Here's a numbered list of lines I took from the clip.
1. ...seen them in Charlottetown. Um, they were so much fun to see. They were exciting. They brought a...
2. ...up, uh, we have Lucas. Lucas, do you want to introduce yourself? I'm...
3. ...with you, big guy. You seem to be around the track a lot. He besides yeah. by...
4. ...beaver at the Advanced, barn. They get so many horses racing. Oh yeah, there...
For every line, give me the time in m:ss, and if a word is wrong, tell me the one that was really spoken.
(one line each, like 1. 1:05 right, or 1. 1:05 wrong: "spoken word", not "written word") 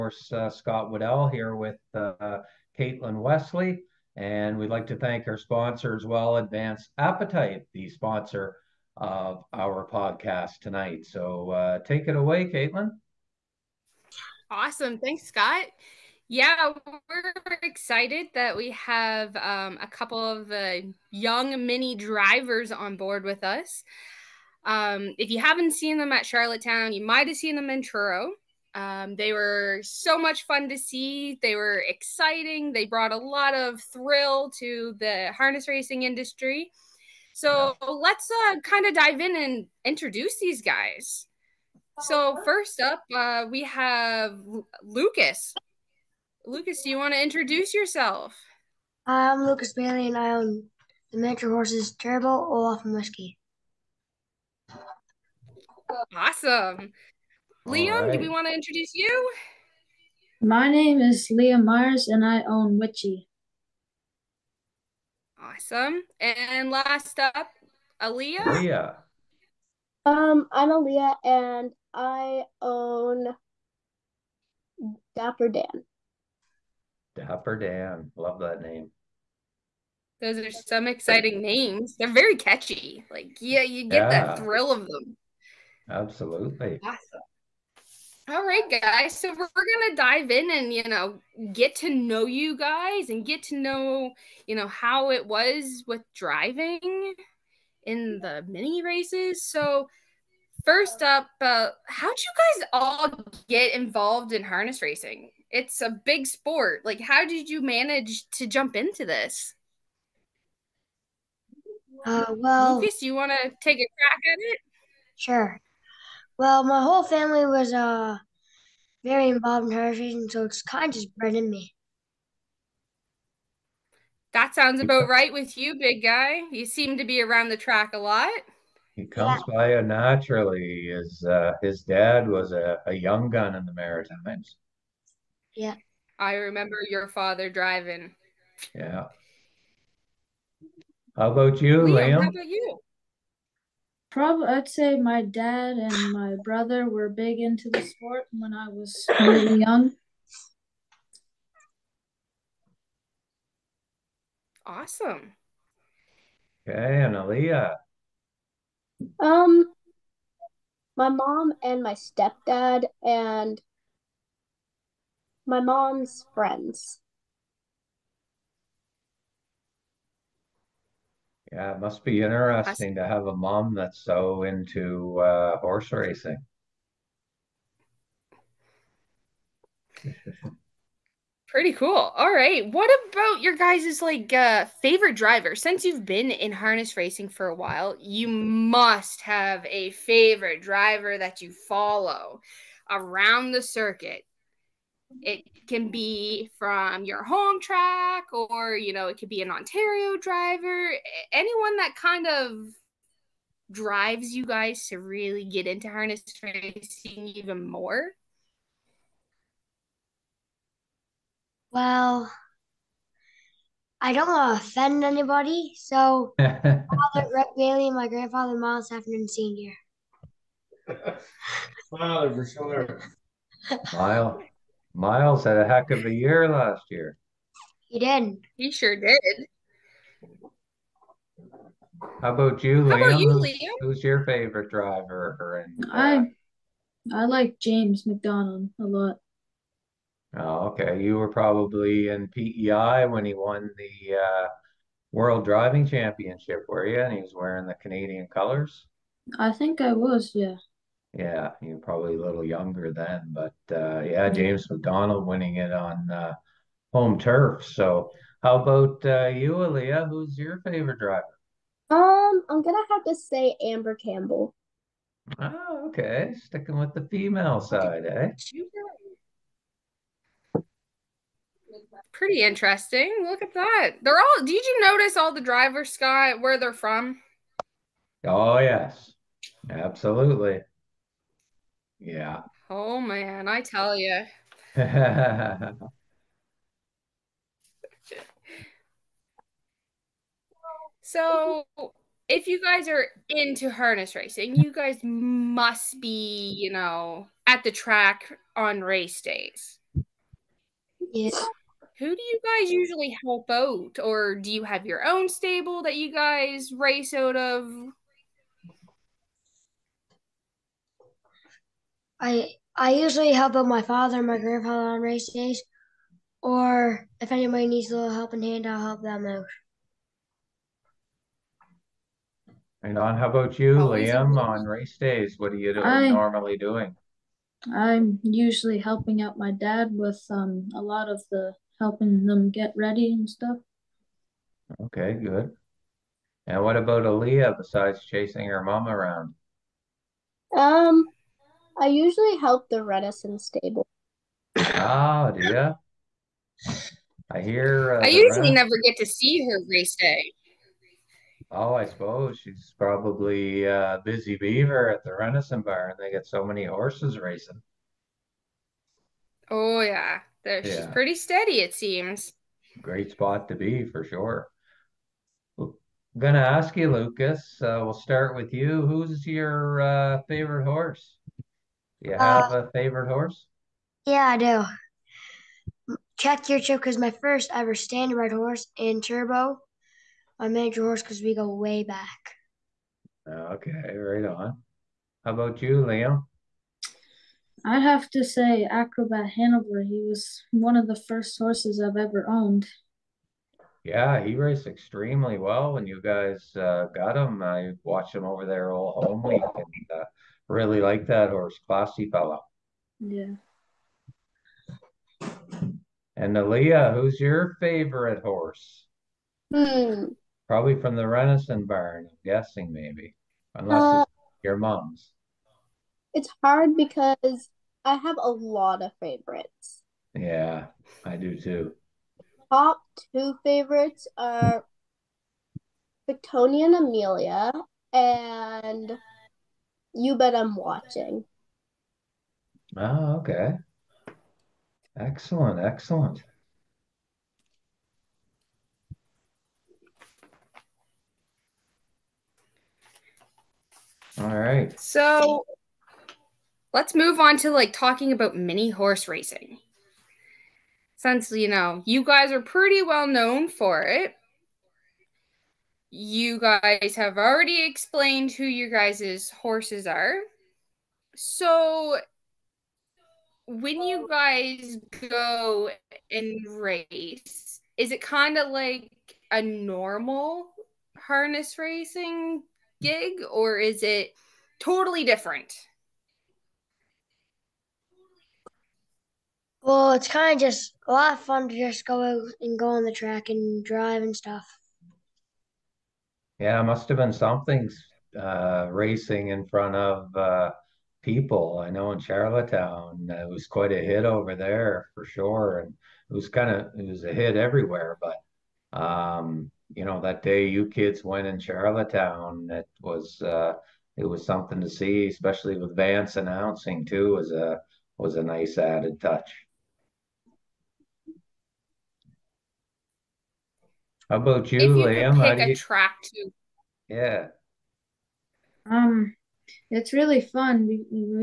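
1. 0:27 wrong: "Truro", not "Charlottetown"
2. 0:42 right
3. 2:05 wrong: "comes", not "besides"
4. 5:54 wrong: "Bar", not "Advanced".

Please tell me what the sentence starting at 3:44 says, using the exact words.
Miles had a heck of a year last year.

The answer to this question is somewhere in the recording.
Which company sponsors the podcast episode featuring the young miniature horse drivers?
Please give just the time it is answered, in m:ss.
0:06.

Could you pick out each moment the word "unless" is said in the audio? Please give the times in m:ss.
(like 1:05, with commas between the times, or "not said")
6:53.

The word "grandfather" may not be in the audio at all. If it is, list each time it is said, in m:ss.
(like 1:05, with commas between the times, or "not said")
3:38, 5:14.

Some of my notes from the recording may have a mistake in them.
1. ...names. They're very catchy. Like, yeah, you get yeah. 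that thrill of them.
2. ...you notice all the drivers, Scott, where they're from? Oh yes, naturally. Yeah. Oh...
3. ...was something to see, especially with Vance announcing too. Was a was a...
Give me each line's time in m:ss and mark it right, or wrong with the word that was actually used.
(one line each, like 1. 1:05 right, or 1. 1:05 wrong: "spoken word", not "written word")
1. 1:21 right
2. 4:34 wrong: "absolutely", not "naturally"
3. 8:24 right.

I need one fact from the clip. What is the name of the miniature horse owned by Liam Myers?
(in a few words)
Witchy.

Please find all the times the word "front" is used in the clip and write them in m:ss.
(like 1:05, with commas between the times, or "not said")
8:09.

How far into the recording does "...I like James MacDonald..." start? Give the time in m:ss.
3:57.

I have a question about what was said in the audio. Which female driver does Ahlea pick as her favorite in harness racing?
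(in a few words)
Amber Campbell.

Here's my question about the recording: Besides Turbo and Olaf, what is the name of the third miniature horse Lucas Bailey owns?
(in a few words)
Whiskey.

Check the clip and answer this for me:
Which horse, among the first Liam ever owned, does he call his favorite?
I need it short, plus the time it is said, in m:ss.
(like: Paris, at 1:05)
Acrobat Hanover, at 6:28.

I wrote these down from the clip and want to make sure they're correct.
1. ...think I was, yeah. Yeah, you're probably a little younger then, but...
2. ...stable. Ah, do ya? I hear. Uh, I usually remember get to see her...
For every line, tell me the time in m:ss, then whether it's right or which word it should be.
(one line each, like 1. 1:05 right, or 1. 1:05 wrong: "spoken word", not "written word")
1. 4:09 right
2. 5:43 wrong: "never", not "remember".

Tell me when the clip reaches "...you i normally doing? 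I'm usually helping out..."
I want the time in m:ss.
5:25.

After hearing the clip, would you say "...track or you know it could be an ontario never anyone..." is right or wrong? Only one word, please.
wrong.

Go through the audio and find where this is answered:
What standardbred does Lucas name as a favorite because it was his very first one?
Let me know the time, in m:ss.
6:16.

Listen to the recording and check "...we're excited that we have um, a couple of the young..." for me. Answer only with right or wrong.
right.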